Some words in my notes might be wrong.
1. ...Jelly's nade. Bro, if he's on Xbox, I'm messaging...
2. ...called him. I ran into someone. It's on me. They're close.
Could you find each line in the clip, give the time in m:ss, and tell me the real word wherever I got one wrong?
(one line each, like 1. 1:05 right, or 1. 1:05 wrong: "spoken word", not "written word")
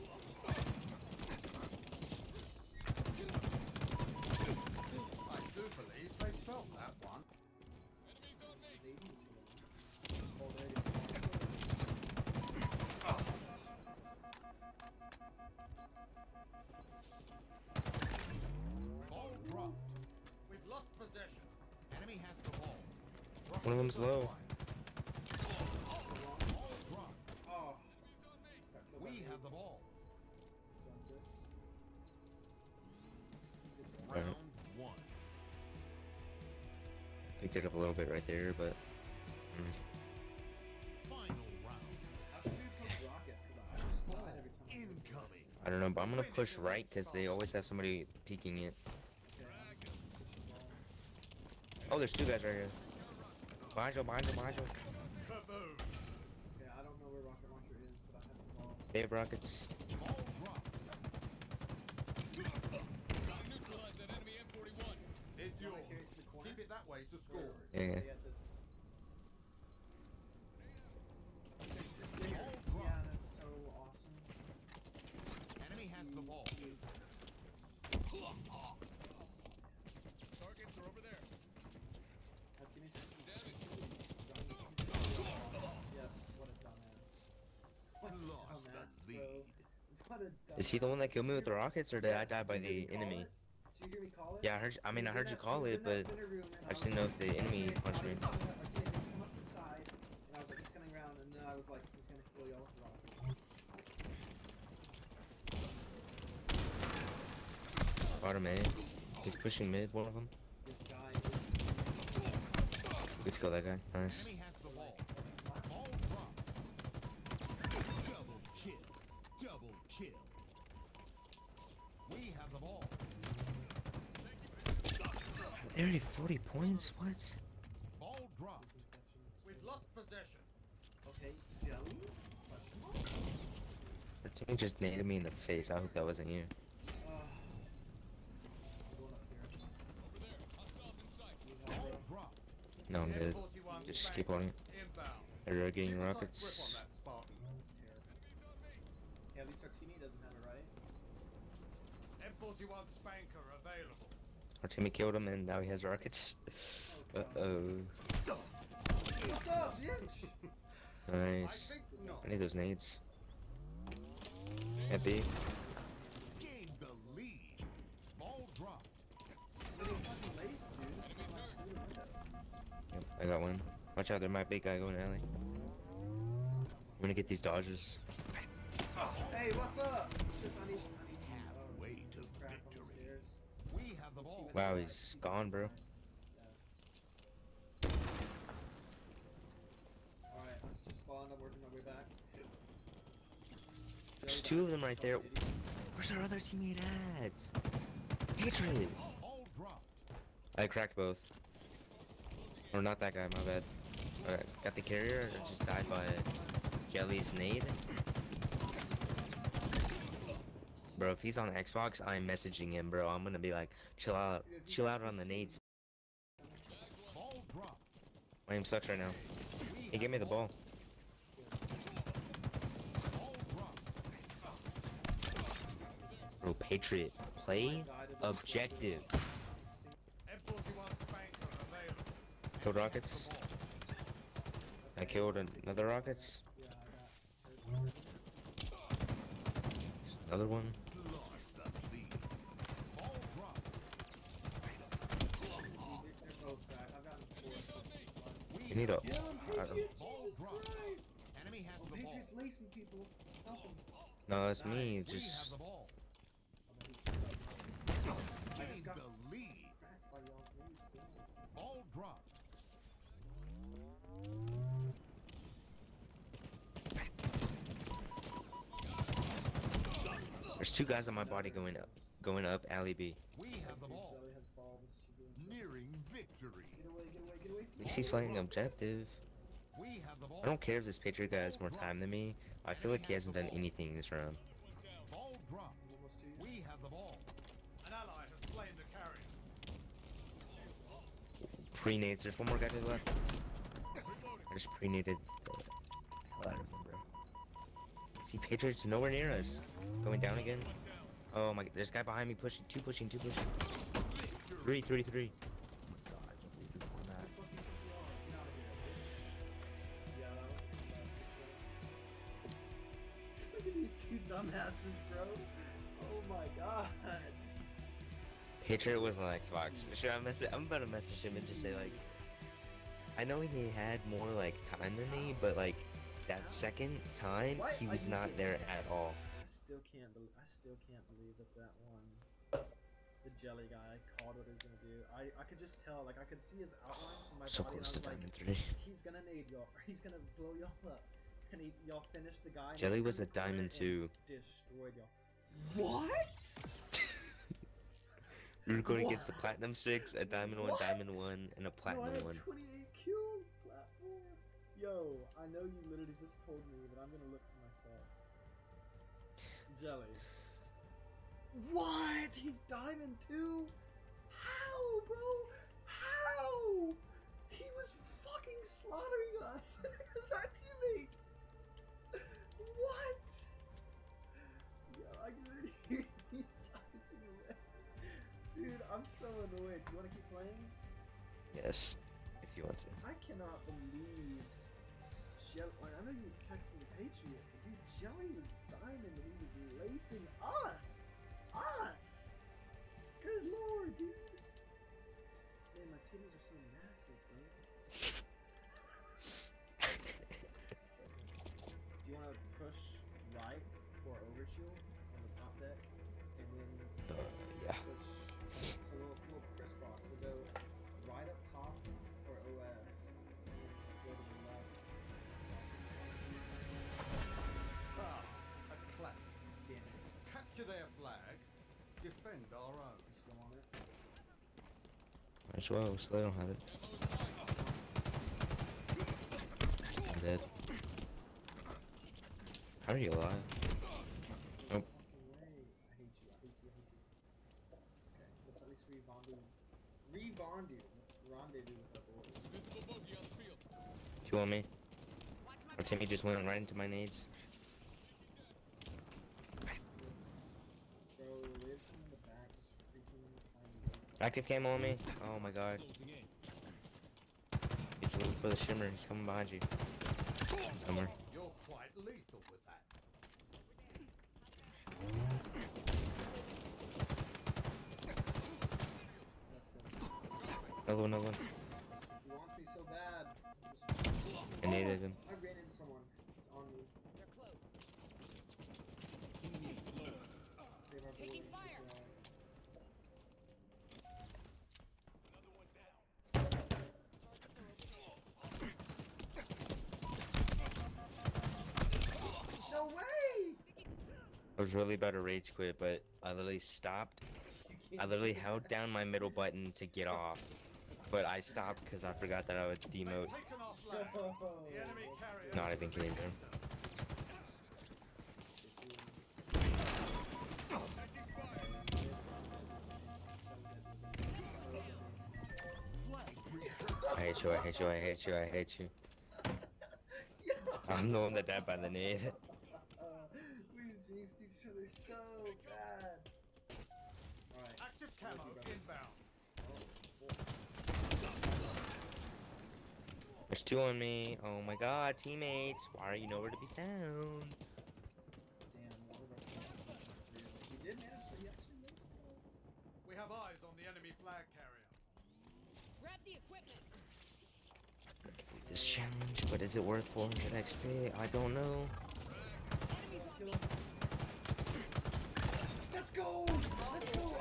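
1. 3:26 right
2. 7:54 wrong: "needed", not "called".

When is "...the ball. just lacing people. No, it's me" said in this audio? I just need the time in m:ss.
4:11.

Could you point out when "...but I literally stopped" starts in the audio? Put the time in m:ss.
8:15.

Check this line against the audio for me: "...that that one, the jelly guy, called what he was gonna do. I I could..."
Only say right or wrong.
right.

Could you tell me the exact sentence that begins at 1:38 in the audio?
Come up the side, and I was like, he's coming around, and then I was like, he's gonna kill y'all with rockets.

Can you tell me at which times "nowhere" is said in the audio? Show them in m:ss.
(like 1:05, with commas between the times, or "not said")
4:58, 8:56.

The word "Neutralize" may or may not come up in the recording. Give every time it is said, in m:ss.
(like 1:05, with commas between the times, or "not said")
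1:03.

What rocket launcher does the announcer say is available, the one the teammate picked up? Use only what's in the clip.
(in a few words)
M41 Spanker.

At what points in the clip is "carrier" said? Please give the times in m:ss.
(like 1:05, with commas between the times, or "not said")
3:24, 4:48, 9:04.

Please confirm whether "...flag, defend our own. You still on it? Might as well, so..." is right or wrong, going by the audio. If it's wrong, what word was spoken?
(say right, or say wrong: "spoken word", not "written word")
right.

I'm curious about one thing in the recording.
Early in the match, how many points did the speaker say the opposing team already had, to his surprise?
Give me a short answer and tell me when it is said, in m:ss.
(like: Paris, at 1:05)
40, at 2:05.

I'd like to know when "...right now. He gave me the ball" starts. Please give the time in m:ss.
3:38.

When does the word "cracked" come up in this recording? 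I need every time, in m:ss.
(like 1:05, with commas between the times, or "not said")
3:20.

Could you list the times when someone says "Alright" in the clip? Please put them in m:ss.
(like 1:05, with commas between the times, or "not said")
3:10, 3:24, 8:47.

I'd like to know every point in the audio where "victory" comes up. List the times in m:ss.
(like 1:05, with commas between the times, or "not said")
3:02, 4:35.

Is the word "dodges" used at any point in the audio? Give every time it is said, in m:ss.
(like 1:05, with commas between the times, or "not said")
2:57.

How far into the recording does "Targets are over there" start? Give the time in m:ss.
1:20.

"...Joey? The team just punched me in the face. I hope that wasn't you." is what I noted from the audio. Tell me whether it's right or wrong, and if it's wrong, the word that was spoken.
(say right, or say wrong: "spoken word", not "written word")
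wrong: "nailed", not "punched".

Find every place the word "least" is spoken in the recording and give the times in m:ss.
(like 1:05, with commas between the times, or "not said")
2:29, 4:37, 7:18.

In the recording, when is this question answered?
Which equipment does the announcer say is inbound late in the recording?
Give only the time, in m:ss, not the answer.
8:47.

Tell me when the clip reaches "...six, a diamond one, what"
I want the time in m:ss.
5:49.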